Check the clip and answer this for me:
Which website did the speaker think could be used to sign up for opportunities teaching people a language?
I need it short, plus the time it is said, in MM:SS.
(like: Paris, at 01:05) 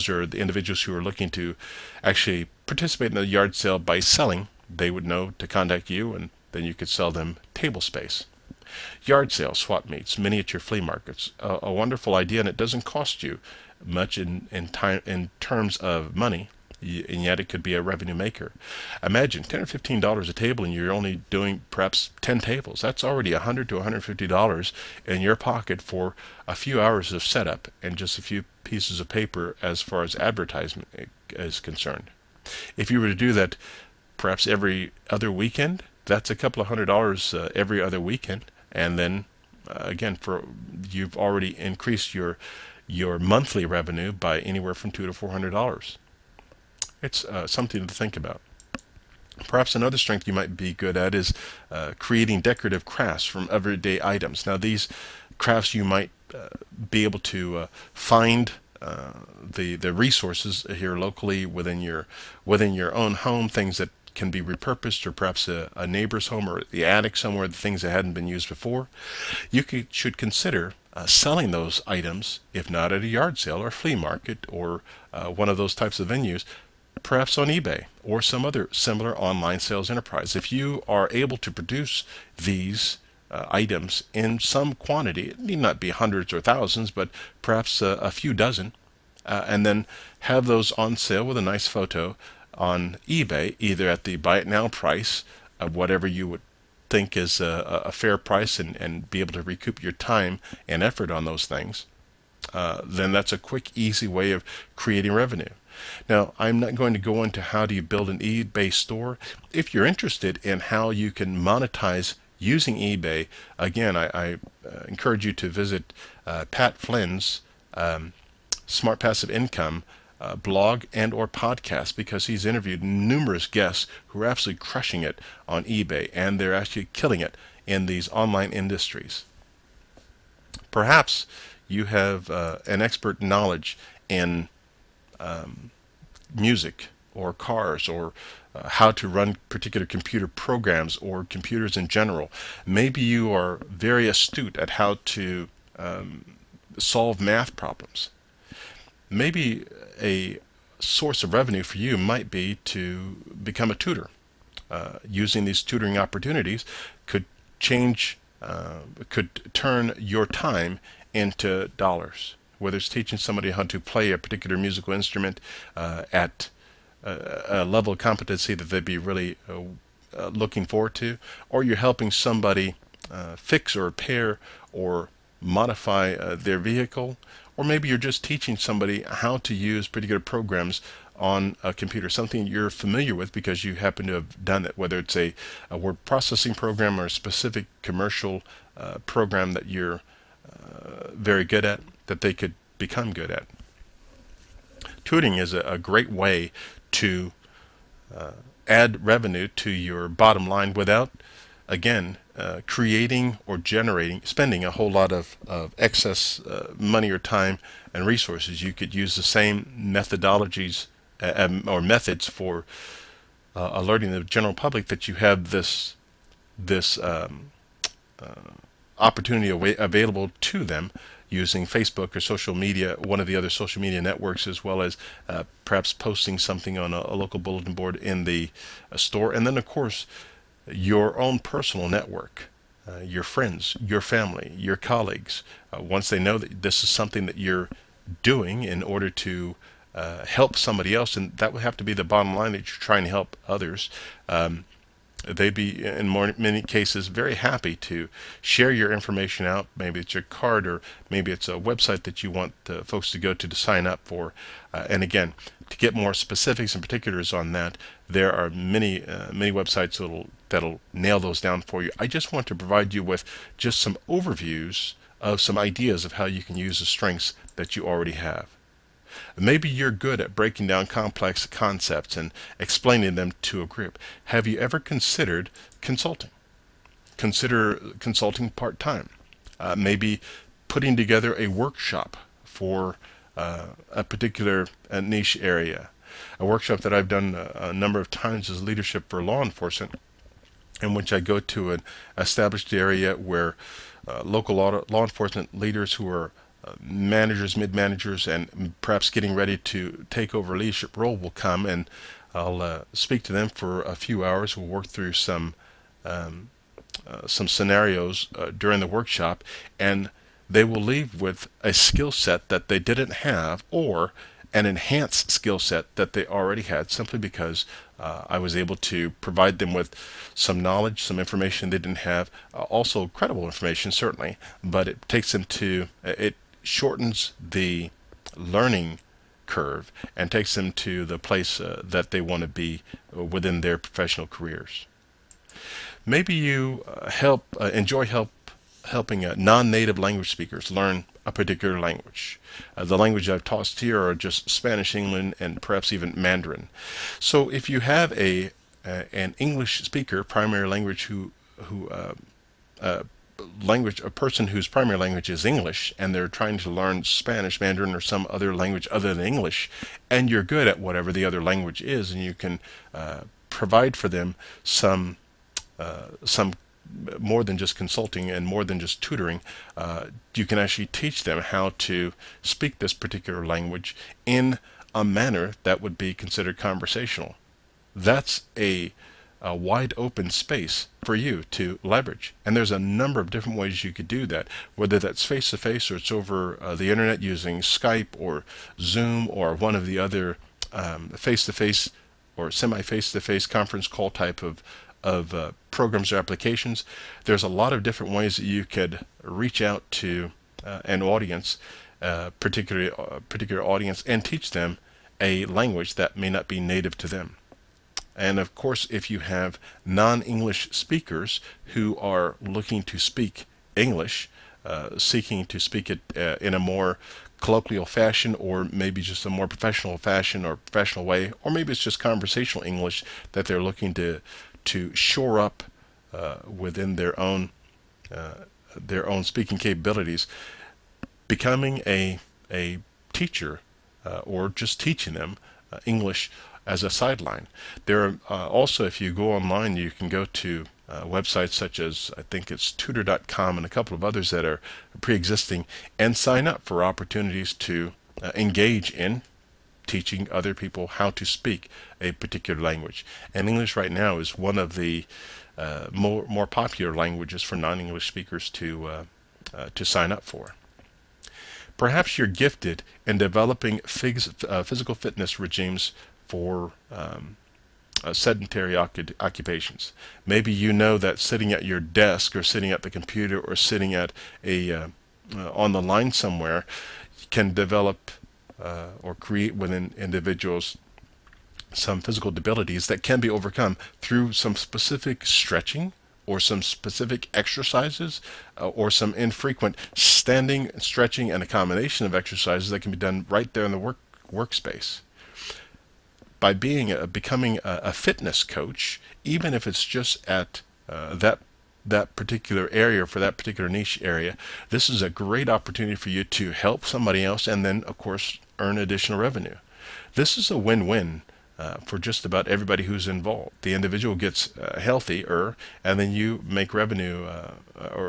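tutor.com, at 07:22.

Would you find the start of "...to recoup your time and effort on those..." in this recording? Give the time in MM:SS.
01:39.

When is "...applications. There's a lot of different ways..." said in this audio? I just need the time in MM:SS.
06:36.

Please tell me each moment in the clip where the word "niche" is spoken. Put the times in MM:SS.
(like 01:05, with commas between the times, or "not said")
04:45, 08:23.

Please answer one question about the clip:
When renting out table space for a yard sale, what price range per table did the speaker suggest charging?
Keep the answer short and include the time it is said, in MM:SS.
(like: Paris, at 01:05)
10 or 15 dollars, at 00:19.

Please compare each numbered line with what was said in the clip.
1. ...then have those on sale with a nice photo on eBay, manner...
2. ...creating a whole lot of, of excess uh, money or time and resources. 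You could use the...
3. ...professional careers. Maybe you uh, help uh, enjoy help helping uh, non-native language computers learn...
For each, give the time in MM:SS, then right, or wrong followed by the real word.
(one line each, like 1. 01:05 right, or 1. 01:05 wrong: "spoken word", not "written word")
1. 01:29 wrong: "either", not "manner"
2. 03:24 wrong: "spending", not "creating"
3. 05:33 wrong: "speakers", not "computers".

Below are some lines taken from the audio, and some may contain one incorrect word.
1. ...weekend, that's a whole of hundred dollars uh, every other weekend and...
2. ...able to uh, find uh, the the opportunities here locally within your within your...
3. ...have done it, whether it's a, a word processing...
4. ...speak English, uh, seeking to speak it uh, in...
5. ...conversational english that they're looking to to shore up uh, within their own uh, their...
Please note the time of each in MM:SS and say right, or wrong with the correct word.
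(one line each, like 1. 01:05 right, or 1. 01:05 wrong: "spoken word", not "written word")
1. 00:35 wrong: "couple", not "whole"
2. 00:57 wrong: "resources", not "opportunities"
3. 03:04 right
4. 06:52 right
5. 07:01 right.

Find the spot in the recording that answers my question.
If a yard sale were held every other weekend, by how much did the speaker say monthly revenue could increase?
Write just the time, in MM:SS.
00:44.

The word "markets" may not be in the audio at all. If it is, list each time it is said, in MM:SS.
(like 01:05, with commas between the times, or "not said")
00:10, 01:13.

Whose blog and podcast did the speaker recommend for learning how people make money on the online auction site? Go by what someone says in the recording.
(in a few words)
Pat Flynn.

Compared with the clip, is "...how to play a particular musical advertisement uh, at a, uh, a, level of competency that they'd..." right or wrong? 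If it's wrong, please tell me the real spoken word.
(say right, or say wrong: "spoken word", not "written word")
wrong: "instrument", not "advertisement".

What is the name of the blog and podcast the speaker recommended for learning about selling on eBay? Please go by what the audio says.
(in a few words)
Smart Passive Income.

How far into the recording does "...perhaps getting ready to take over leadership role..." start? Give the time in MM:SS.
04:58.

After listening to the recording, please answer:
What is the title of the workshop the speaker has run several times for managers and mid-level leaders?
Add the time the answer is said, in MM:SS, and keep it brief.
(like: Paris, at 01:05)
Leadership for Law Enforcement, at 04:48.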